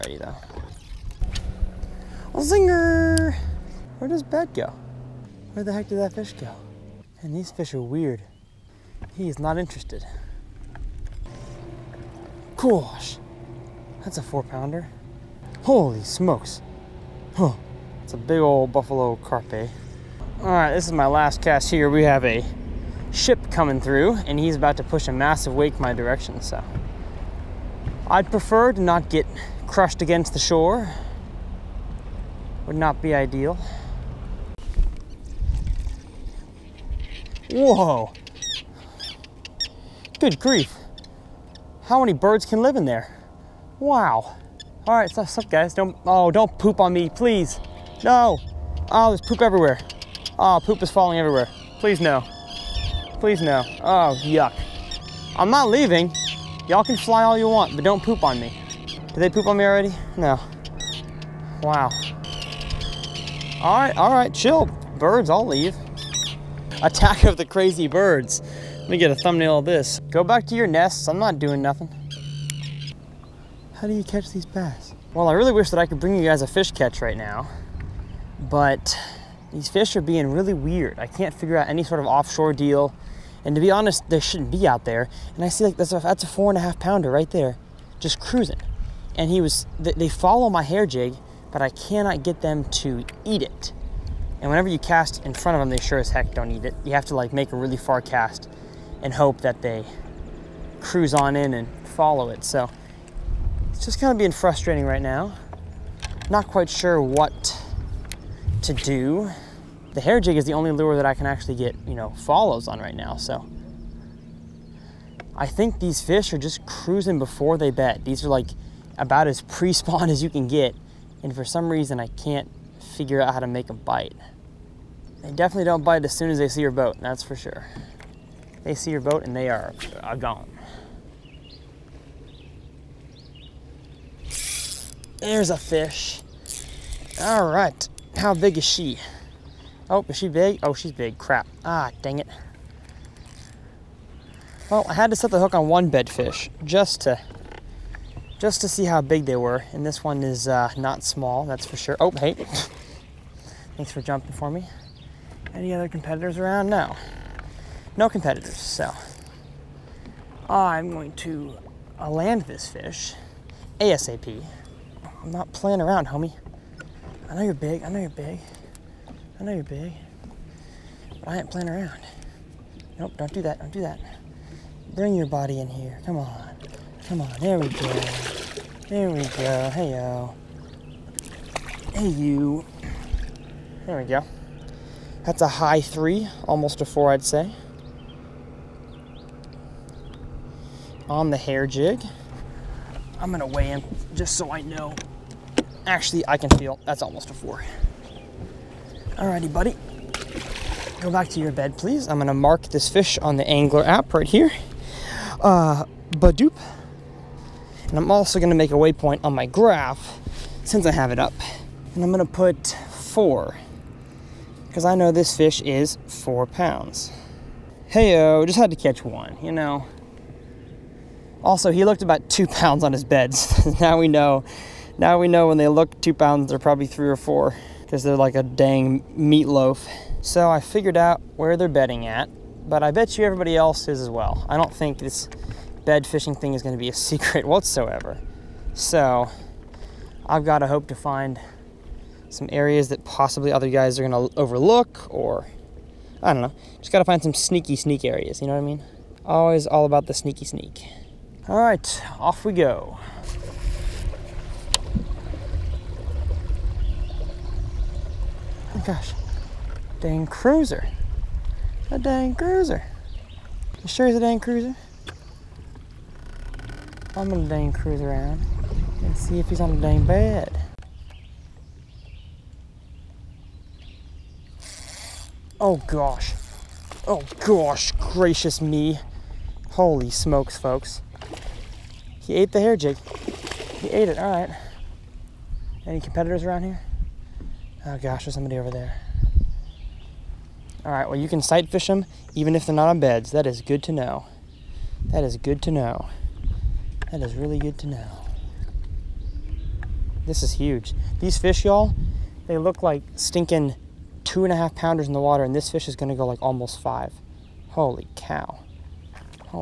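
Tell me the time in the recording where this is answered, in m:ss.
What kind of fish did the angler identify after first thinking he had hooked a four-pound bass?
0:18.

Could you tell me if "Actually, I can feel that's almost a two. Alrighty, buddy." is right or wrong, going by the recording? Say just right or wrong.
wrong.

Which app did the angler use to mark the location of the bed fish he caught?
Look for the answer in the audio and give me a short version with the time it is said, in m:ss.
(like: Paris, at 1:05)
ANGLR, at 3:23.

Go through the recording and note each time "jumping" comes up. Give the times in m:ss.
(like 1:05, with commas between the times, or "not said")
2:33.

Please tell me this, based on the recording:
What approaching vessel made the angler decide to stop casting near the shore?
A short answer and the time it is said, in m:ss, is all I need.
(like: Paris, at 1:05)
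A ship, at 0:23.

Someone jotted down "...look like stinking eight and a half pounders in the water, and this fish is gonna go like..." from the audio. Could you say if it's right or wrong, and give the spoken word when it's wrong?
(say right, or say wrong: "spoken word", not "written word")
wrong: "two", not "eight".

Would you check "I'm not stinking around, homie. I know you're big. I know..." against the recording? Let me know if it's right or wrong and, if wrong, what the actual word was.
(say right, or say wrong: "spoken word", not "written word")
wrong: "playing", not "stinking".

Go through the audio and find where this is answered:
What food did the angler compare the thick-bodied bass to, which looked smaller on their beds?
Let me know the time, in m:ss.
3:49.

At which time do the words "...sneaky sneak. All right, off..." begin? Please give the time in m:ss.
4:10.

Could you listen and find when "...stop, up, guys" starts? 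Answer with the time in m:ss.
0:45.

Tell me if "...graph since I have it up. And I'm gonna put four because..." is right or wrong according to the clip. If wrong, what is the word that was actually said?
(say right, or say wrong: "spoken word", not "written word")
right.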